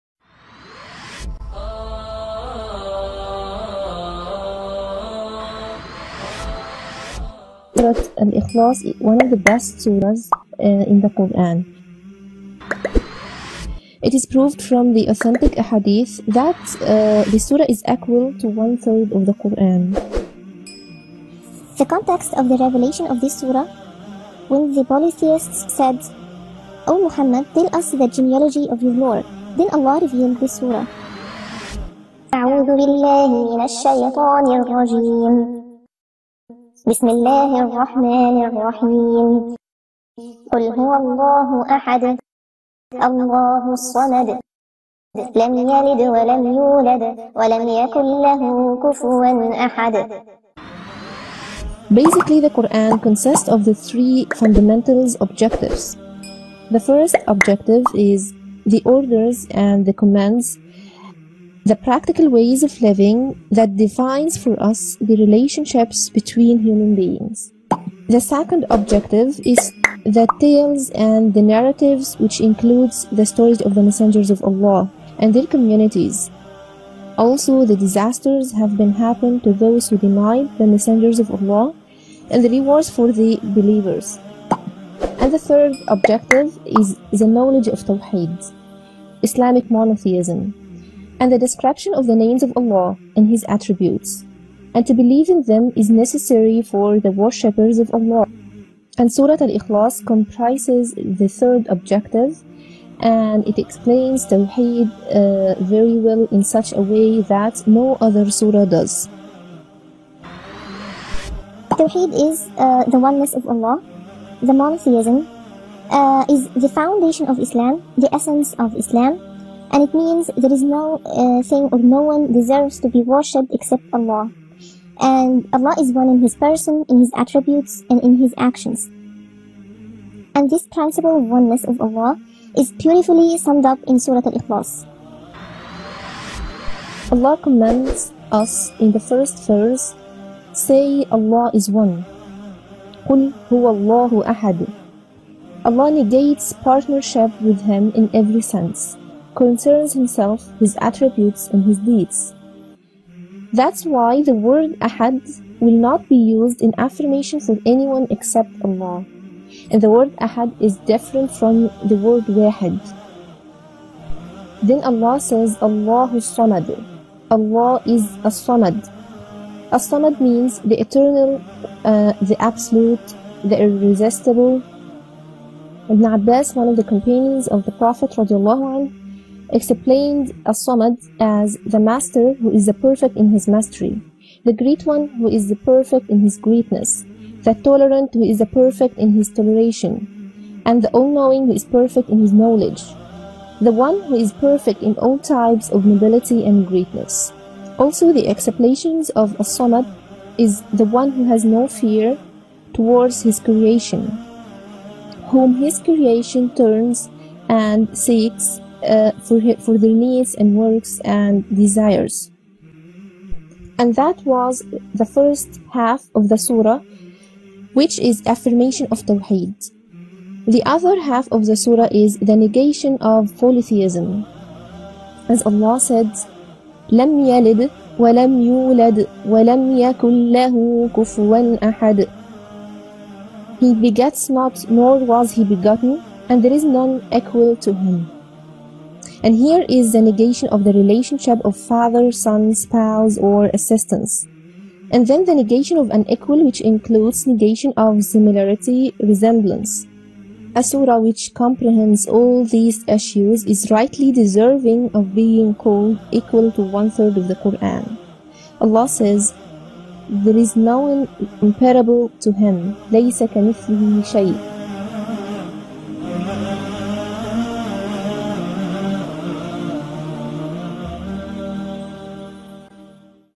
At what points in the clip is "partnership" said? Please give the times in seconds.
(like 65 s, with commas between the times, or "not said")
146 s.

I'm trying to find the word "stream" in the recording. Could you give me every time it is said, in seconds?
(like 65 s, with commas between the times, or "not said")
not said.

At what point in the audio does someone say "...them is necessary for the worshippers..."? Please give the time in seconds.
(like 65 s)
95 s.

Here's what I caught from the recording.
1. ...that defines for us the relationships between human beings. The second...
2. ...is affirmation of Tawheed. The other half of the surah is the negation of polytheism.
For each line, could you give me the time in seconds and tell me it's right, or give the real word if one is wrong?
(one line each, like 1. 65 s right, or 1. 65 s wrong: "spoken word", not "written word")
1. 63 s right
2. 217 s right.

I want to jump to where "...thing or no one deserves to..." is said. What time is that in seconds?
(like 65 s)
121 s.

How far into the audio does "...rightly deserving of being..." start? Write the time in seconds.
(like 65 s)
253 s.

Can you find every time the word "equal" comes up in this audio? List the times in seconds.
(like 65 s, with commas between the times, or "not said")
17 s, 237 s, 246 s, 256 s.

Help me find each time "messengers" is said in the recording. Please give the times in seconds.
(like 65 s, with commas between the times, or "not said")
73 s, 80 s.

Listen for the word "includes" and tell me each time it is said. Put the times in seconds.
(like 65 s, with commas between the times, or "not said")
72 s, 246 s.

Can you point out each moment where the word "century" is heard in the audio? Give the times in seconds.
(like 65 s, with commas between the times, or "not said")
not said.